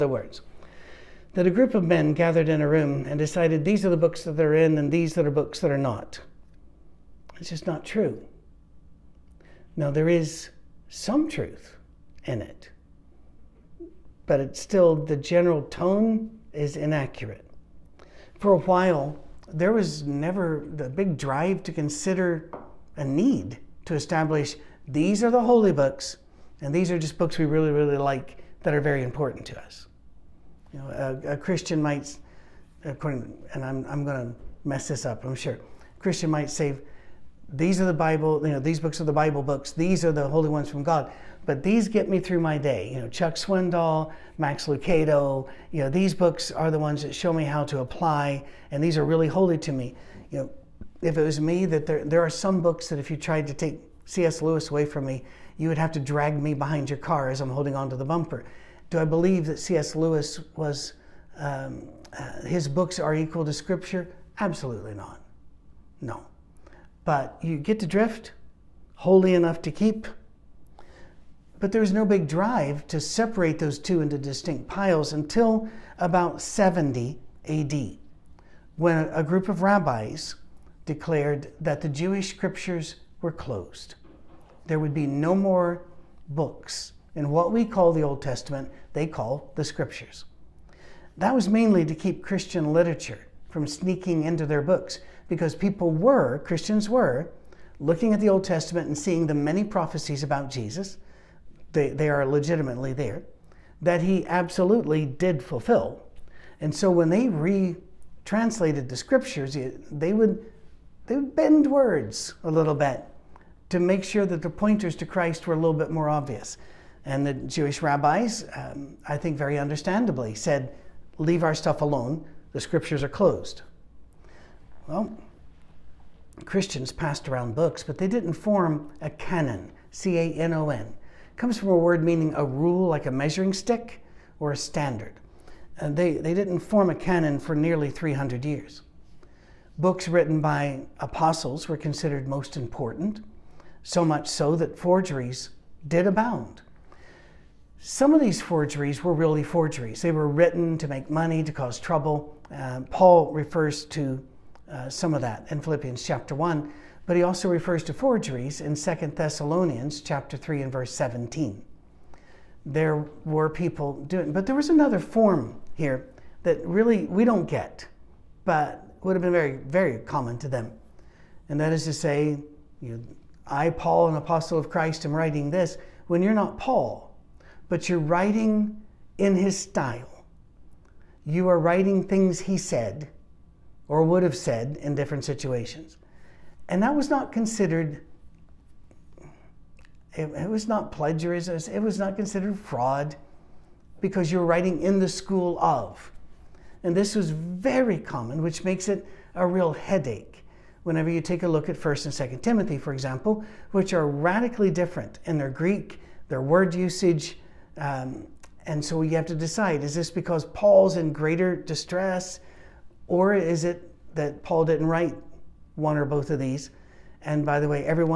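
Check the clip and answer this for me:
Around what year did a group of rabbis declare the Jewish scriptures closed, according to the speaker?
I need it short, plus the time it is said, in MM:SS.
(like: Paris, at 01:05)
70 AD, at 01:16.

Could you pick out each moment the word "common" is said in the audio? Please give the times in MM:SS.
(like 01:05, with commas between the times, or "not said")
02:50, 03:17.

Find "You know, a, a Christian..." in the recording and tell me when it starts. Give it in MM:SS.
00:30.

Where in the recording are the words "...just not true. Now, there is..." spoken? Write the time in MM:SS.
00:07.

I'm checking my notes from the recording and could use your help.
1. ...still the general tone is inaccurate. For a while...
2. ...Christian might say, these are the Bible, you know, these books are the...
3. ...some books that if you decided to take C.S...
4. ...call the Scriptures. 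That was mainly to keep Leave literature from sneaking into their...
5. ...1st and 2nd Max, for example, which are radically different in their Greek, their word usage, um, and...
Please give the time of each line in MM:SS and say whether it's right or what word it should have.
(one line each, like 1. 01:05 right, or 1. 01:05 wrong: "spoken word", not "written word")
1. 00:14 right
2. 00:36 right
3. 00:52 wrong: "tried", not "decided"
4. 01:29 wrong: "Christian", not "Leave"
5. 03:21 wrong: "Timothy", not "Max".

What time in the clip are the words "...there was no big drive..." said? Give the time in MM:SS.
01:11.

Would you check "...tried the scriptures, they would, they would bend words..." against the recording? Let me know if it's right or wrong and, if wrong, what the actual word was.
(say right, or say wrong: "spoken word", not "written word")
wrong: "retranslated", not "tried".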